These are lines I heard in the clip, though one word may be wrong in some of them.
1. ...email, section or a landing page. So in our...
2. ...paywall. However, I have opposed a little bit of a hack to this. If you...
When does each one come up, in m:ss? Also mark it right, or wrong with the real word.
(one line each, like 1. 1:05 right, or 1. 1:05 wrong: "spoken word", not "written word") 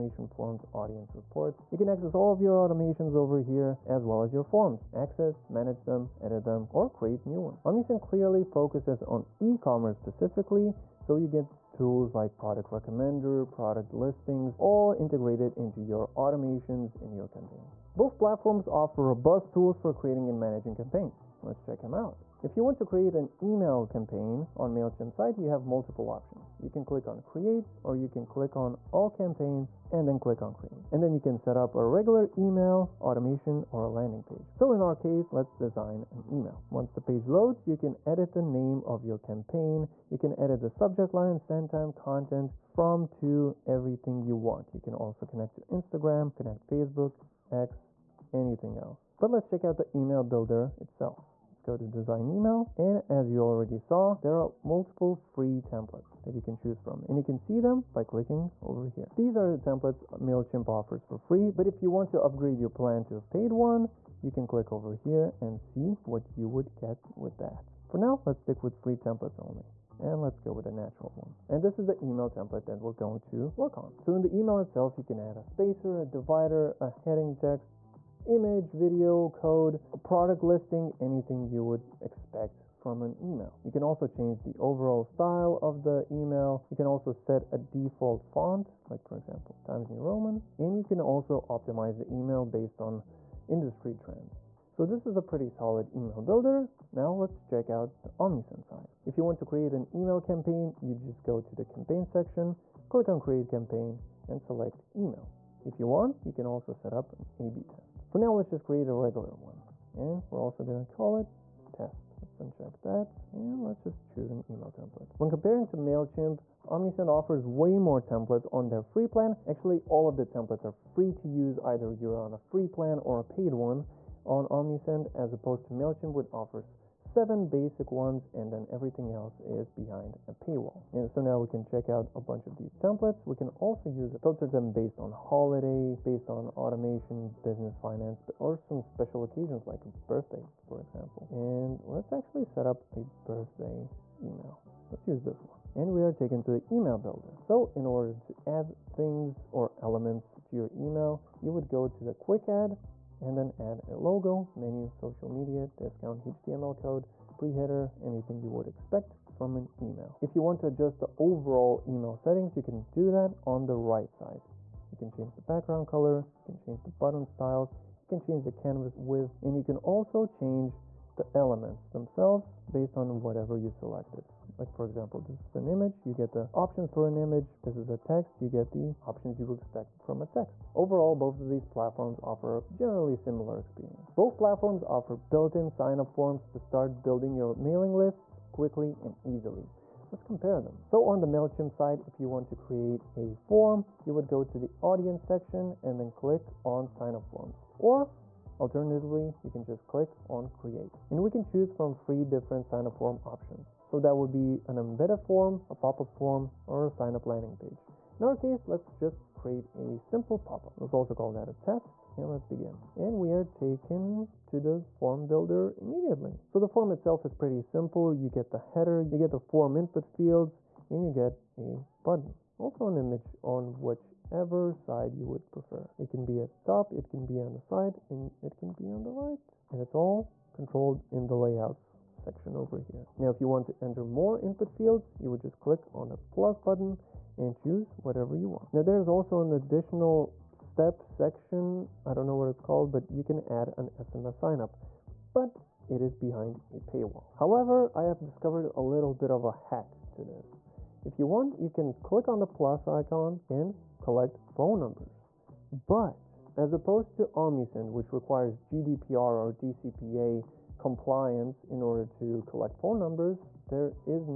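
1. 0:32 wrong: "automation", not "section"
2. 4:06 wrong: "discovered", not "opposed".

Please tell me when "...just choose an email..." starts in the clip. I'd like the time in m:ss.
1:53.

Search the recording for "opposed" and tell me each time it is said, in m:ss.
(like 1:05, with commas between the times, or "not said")
2:05, 4:16.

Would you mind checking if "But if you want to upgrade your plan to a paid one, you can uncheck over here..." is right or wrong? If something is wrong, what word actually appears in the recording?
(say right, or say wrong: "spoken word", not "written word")
wrong: "click", not "uncheck".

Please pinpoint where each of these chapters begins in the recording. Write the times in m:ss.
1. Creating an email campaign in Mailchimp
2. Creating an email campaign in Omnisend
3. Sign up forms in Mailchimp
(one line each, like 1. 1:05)
1. 0:17
2. 1:36
3. 3:10.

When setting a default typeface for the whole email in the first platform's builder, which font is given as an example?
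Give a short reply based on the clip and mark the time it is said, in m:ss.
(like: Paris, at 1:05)
Times New Roman, at 1:29.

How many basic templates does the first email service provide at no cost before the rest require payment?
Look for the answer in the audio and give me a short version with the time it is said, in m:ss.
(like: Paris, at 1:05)
7, at 2:06.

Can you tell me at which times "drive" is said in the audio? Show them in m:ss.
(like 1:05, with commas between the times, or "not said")
not said.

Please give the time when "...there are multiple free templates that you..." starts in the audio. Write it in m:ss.
0:54.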